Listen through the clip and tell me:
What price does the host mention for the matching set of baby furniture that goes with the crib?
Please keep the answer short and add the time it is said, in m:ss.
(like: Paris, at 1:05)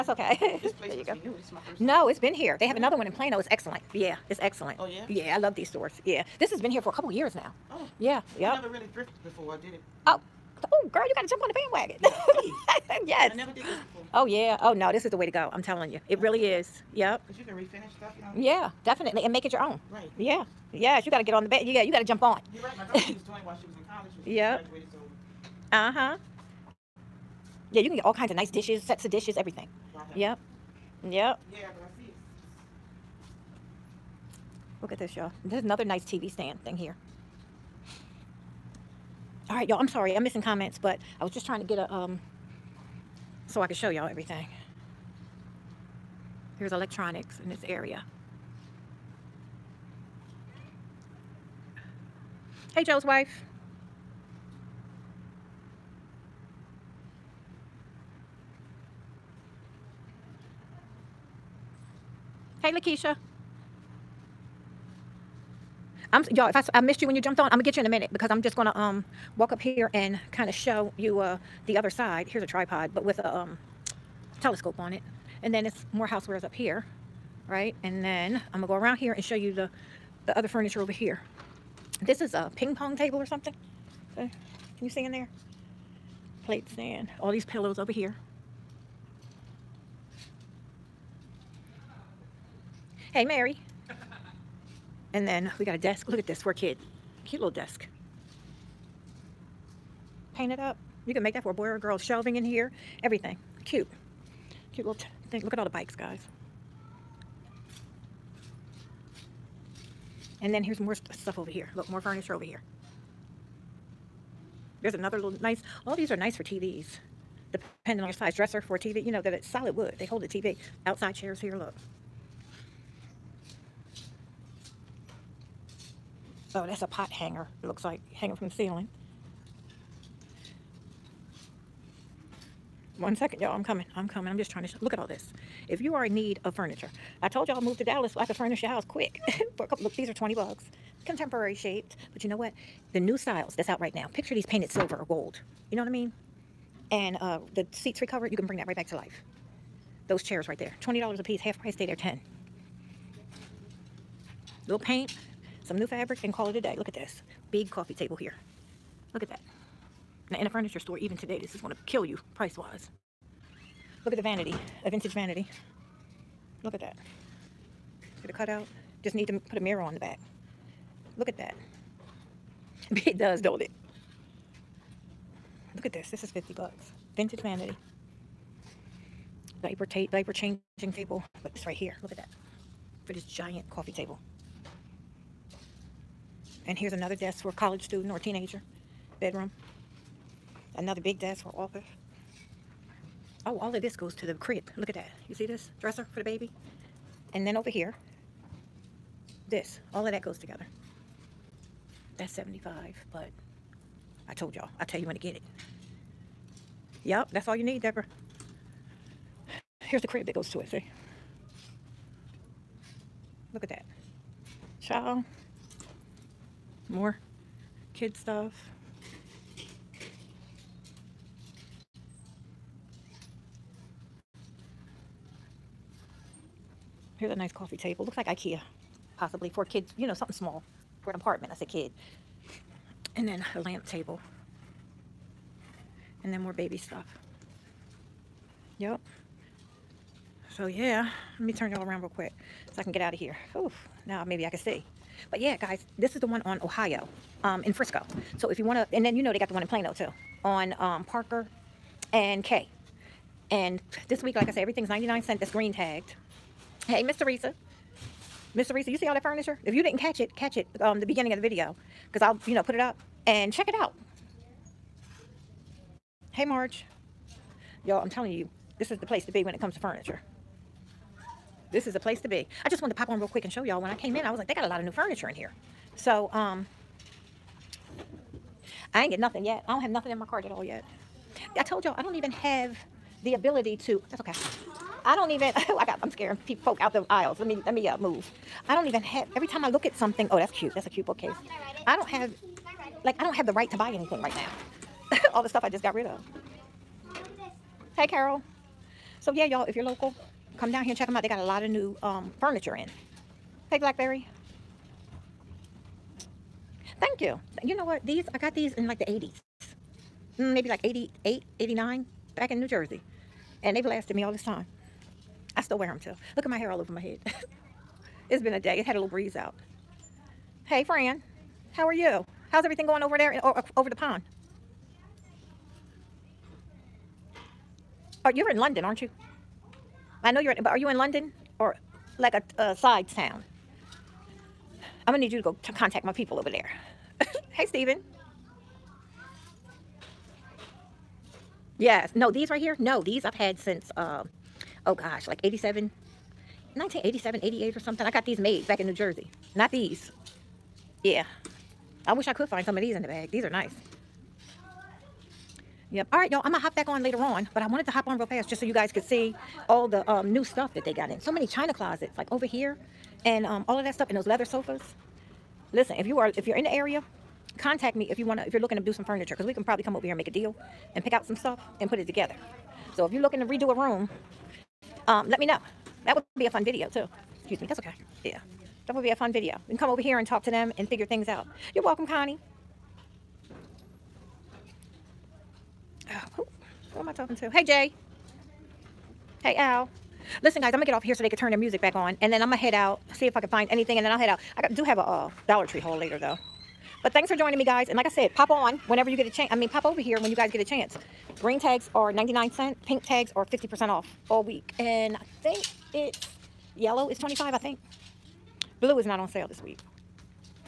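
75, at 3:22.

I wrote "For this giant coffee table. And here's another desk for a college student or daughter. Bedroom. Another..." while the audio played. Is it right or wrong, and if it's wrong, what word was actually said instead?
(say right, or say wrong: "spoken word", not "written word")
wrong: "teenager", not "daughter".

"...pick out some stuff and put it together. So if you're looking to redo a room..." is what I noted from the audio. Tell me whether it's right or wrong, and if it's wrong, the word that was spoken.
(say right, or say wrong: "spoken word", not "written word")
right.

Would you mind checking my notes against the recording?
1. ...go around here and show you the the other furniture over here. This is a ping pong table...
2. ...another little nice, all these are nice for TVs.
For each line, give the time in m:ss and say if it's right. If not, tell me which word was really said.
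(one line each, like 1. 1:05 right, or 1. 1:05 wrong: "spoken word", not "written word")
1. 1:18 right
2. 1:54 right.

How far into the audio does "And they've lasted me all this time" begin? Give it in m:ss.
5:13.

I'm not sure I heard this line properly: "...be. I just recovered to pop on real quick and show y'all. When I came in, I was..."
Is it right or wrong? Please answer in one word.
wrong.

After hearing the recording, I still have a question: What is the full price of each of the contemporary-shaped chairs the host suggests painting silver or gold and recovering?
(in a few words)
$20.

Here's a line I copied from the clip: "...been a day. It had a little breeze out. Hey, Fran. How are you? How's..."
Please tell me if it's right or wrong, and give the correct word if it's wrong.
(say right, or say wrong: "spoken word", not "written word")
right.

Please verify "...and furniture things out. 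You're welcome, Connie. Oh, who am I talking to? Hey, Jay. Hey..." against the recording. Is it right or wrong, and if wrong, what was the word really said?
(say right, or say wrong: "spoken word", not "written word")
wrong: "figure", not "furniture".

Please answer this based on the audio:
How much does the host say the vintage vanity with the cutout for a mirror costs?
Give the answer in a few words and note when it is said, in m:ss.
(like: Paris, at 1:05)
$50, at 2:56.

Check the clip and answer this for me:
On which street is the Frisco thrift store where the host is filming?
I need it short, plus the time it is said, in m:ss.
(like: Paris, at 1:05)
Ohio, at 4:06.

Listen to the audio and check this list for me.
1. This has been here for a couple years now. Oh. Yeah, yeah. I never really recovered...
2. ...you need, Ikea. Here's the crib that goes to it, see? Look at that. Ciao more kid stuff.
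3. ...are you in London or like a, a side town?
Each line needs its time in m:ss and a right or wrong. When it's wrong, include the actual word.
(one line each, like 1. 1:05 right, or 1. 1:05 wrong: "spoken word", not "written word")
1. 0:06 wrong: "thrifted", not "recovered"
2. 3:27 wrong: "Deborah", not "Ikea"
3. 5:30 right.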